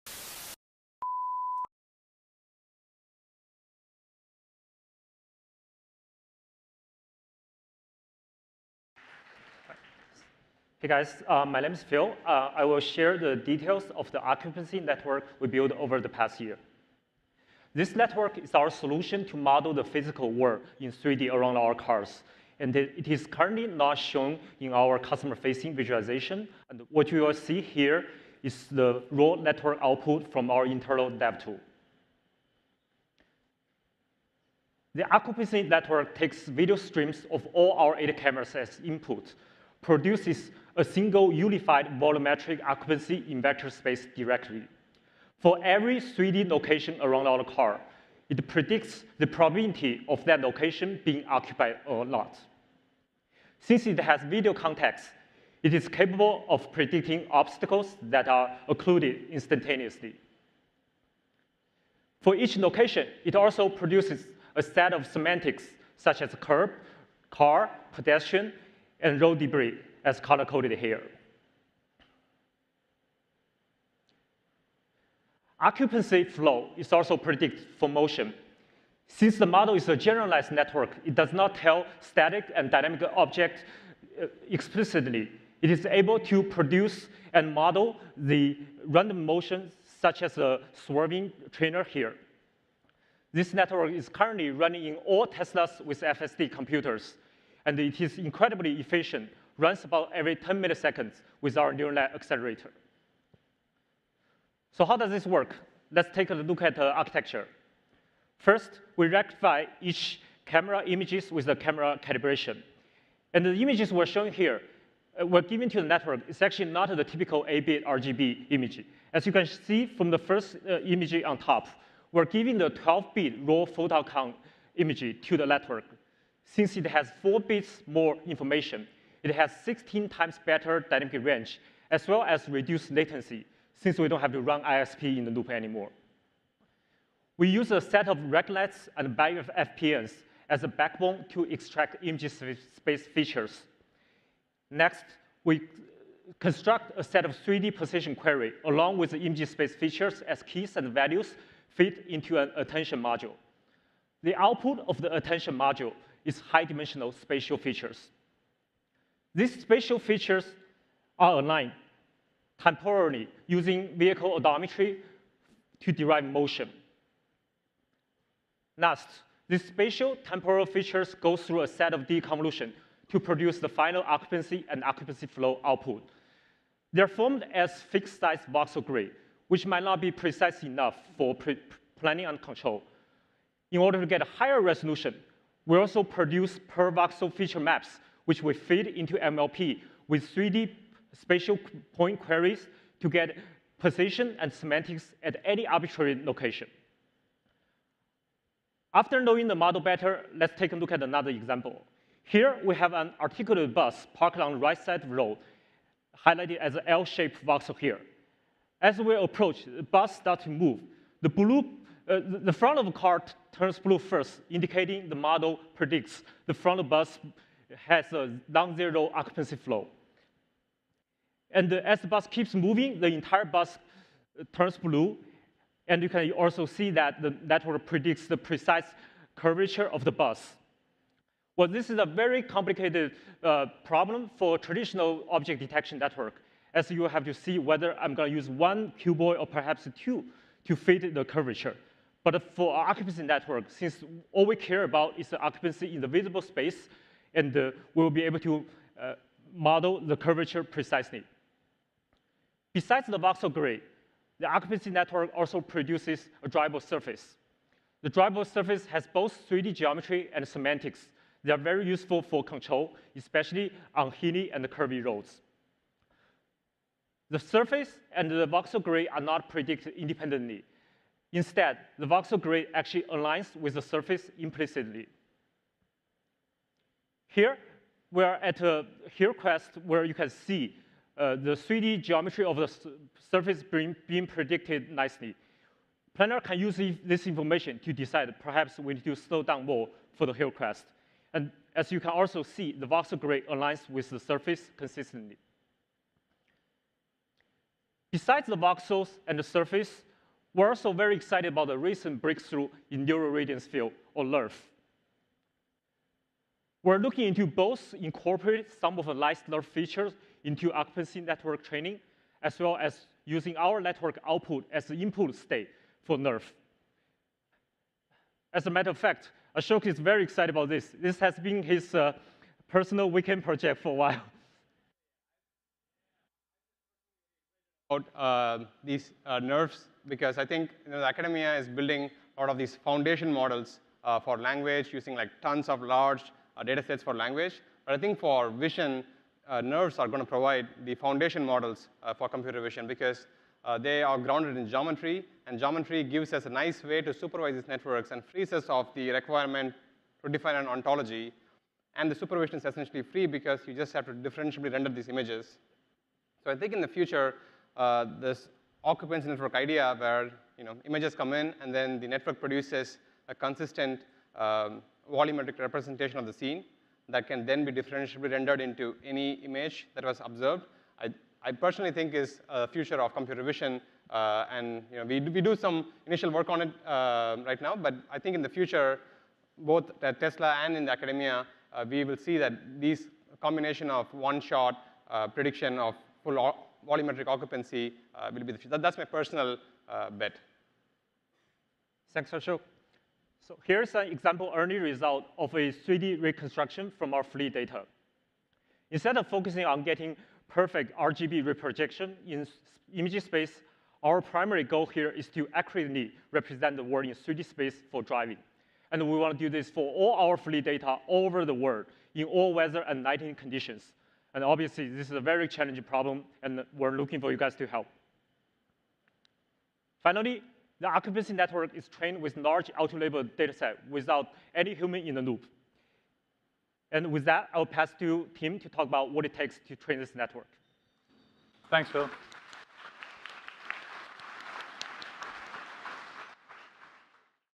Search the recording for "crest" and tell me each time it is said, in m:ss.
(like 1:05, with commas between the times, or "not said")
4:39, 4:50.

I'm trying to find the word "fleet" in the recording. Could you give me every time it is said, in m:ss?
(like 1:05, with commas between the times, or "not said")
6:37, 6:50.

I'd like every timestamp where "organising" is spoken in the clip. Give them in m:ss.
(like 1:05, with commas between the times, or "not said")
not said.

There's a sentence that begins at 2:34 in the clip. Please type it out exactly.
The output of the attention module is high-dimensional spatial features.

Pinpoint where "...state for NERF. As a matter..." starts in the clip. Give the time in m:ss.
5:15.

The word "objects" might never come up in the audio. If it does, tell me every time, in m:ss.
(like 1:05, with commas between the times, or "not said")
1:23, 3:55.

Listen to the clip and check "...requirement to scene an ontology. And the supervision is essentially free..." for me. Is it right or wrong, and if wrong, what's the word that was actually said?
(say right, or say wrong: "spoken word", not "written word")
wrong: "define", not "scene".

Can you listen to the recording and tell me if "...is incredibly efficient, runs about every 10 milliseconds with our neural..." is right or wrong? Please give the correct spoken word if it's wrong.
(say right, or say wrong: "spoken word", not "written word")
right.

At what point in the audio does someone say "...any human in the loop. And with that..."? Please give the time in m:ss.
7:04.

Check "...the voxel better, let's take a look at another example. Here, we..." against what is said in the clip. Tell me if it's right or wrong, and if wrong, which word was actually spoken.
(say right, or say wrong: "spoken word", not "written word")
wrong: "model", not "voxel".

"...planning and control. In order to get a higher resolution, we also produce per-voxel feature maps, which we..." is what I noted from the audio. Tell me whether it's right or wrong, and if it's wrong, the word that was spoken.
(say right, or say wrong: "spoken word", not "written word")
right.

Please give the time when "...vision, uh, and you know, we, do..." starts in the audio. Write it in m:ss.
6:13.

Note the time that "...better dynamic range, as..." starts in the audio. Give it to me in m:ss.
2:10.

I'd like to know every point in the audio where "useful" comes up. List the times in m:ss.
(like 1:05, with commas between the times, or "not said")
4:21.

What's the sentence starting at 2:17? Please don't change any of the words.
We use a set of RegNets and barrier FPNs as a backbone to extract image space features.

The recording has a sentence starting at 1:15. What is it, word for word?
Occupancy flow is also predicted for motion.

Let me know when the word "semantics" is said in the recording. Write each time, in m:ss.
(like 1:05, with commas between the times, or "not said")
1:05, 3:14, 4:20.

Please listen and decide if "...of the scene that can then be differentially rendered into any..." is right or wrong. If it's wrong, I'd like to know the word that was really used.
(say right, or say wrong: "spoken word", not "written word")
right.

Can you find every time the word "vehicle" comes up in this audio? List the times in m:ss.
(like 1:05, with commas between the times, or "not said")
2:43.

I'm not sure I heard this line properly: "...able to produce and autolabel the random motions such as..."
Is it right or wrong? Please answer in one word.
wrong.